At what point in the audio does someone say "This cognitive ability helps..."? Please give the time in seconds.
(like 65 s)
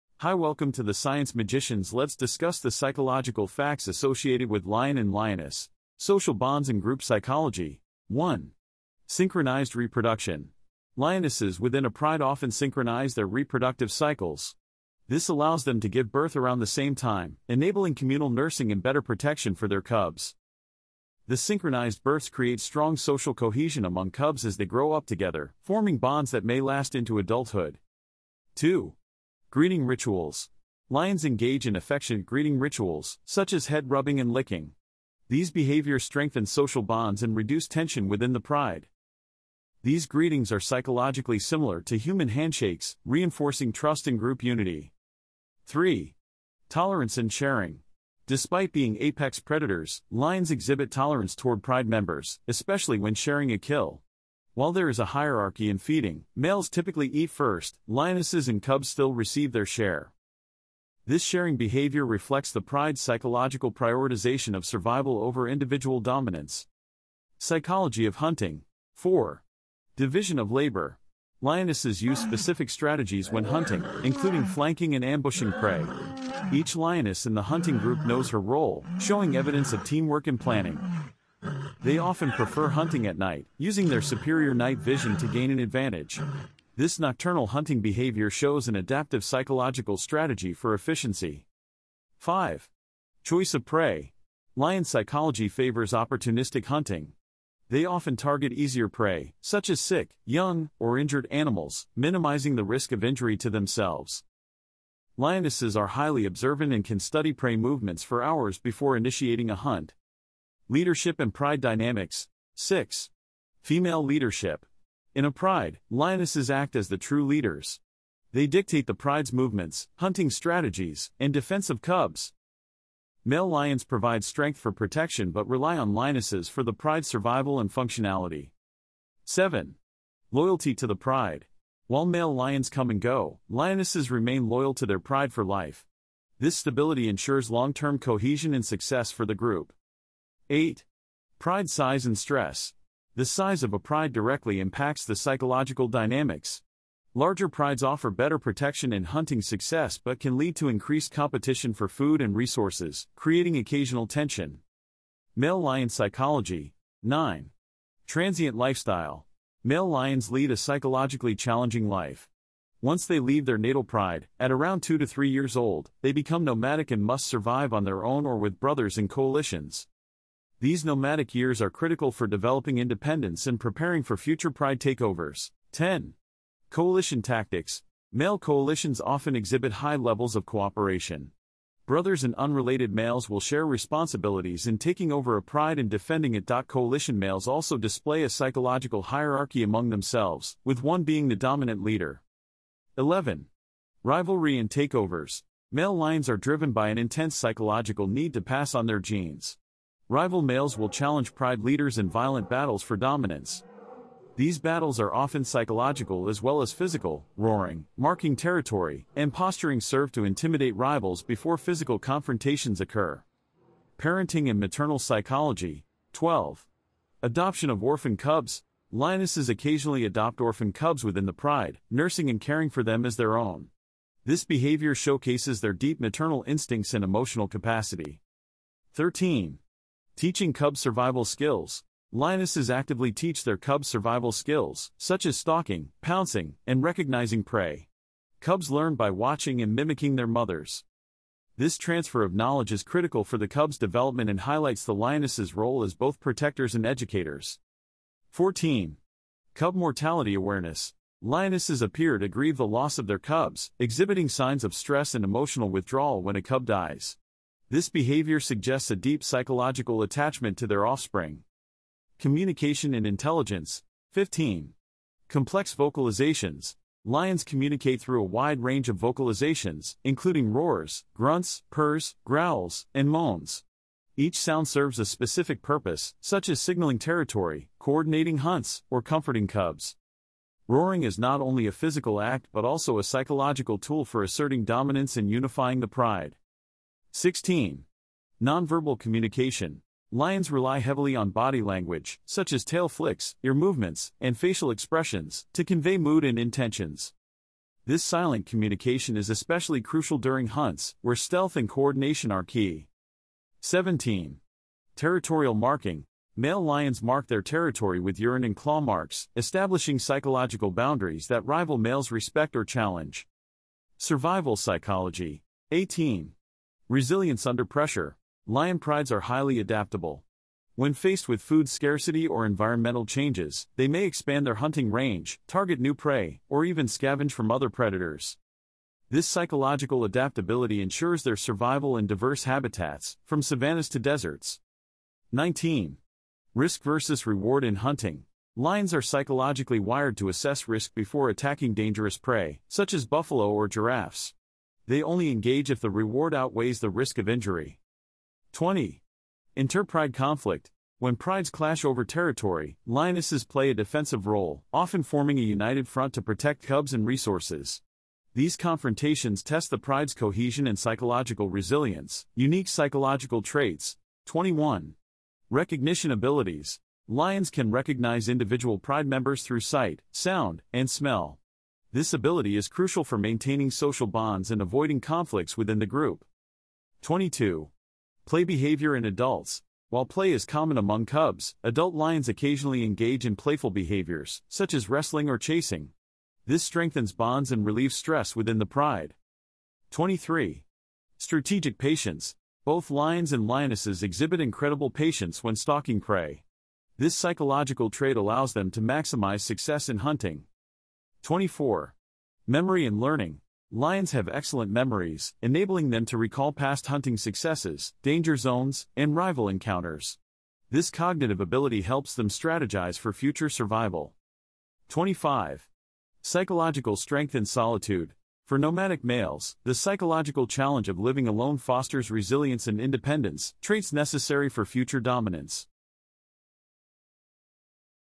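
410 s.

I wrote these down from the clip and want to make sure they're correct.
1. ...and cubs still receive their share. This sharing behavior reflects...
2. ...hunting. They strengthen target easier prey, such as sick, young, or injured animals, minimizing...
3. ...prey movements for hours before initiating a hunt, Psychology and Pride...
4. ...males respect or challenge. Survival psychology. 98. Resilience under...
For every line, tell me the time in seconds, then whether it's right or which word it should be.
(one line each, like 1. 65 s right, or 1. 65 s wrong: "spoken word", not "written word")
1. 58 s right
2. 96 s wrong: "often", not "strengthen"
3. 107 s wrong: "Leadership", not "Psychology"
4. 311 s wrong: "18", not "98".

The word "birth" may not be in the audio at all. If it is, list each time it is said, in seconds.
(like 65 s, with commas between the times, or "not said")
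16 s, 22 s.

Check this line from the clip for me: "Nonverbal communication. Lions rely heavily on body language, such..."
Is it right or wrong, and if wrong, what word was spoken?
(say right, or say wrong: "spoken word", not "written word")
right.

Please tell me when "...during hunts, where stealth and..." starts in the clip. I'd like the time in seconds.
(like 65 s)
300 s.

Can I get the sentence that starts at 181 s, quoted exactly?
Brothers and unrelated males will share responsibilities in taking over a pride and defending it.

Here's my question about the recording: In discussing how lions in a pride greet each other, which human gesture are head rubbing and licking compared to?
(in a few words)
Handshakes.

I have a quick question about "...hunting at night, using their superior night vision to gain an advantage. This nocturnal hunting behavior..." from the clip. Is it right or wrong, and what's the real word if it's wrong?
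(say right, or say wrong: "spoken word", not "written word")
right.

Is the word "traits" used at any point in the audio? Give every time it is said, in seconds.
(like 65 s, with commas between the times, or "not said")
363 s, 397 s, 423 s.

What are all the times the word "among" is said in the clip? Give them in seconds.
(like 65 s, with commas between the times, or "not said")
23 s, 189 s, 380 s.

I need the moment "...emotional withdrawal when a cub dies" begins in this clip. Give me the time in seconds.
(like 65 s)
255 s.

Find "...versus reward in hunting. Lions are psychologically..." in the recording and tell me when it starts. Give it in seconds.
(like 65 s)
336 s.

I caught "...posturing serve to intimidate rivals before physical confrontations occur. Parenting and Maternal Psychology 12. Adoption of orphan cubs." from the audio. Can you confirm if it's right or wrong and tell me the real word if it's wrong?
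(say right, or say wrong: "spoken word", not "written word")
right.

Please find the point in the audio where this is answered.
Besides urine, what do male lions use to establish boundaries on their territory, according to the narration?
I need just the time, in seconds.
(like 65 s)
308 s.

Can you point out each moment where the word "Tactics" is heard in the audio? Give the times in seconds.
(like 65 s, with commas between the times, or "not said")
177 s.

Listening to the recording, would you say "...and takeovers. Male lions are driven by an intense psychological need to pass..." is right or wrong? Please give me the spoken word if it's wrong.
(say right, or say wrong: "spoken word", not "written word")
right.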